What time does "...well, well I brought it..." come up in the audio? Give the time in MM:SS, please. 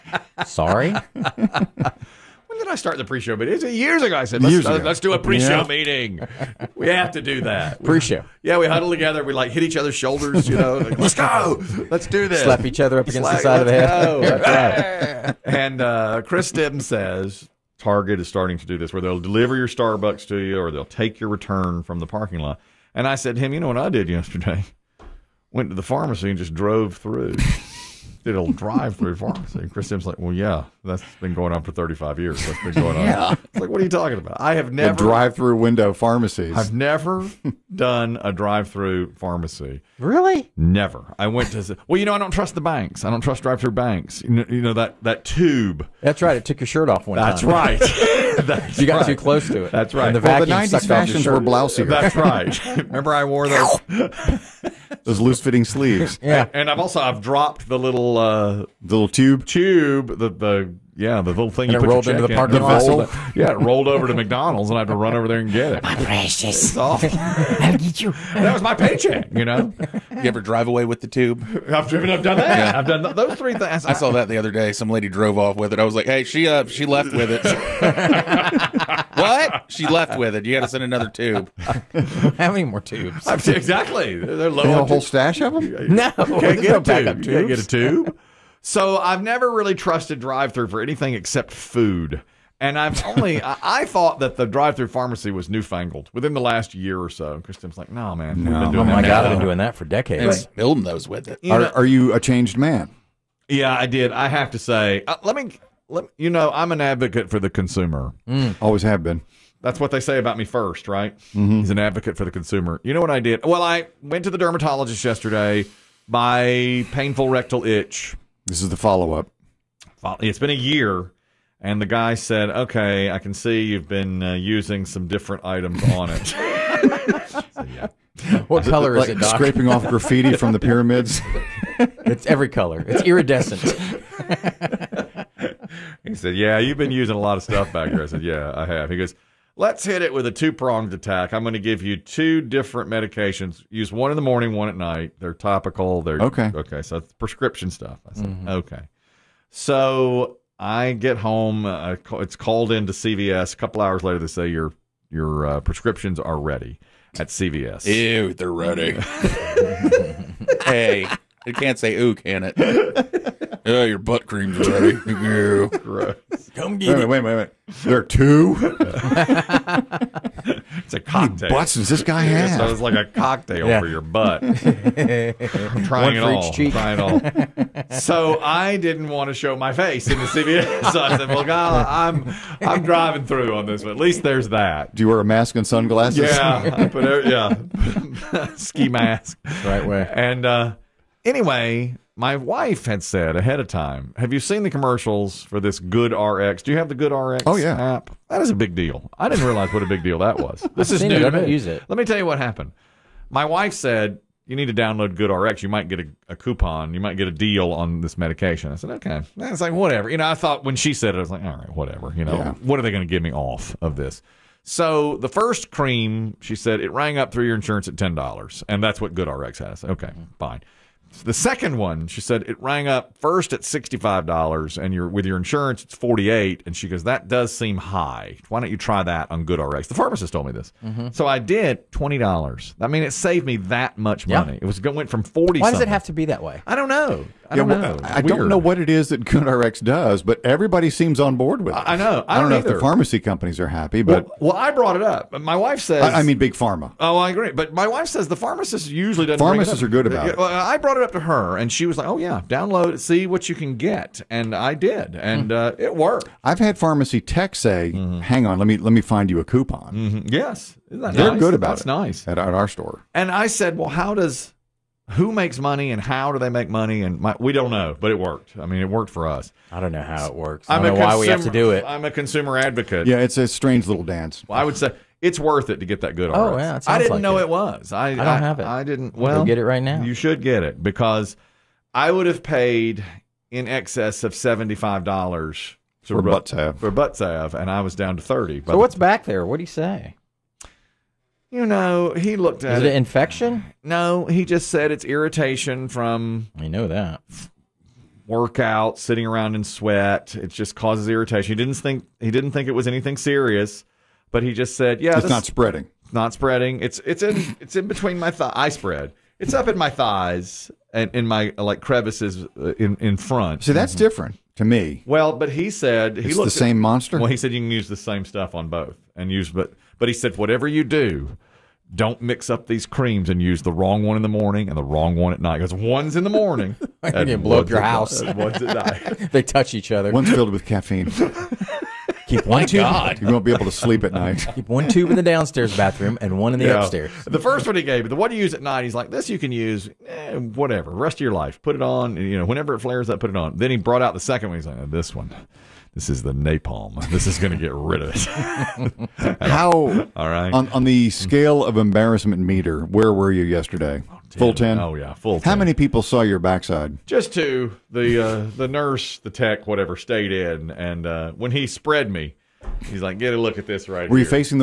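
04:04.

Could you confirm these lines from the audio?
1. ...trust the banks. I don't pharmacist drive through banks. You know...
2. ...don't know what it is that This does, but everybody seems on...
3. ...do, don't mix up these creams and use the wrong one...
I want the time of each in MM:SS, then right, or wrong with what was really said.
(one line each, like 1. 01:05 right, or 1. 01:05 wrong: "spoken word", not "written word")
1. 00:42 wrong: "trust", not "pharmacist"
2. 03:58 wrong: "GoodRx", not "This"
3. 05:20 right.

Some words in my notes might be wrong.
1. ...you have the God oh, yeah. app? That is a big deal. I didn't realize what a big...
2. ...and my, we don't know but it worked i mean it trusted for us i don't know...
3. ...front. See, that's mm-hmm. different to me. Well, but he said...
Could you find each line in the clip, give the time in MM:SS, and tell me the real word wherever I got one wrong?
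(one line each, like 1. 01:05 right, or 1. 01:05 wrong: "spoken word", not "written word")
1. 03:16 wrong: "GoodRx", not "God"
2. 04:27 wrong: "worked", not "trusted"
3. 05:13 right.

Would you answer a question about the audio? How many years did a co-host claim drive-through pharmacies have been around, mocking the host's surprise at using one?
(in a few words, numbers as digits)
35.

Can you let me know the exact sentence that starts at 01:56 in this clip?
My painful rectal itch this is the follow up.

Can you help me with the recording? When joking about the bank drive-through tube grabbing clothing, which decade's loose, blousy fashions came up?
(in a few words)
90s.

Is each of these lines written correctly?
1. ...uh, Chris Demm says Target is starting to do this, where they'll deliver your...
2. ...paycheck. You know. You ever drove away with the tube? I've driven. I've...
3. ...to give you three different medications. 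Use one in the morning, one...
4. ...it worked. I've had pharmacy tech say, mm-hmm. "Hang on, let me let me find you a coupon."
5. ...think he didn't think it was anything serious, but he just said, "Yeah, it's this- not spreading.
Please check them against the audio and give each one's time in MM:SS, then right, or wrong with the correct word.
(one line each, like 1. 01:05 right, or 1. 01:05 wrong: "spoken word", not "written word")
1. 00:15 right
2. 01:08 wrong: "drive", not "drove"
3. 02:21 wrong: "two", not "three"
4. 04:15 right
5. 05:01 right.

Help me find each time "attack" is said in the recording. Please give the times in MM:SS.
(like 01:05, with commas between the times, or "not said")
02:20.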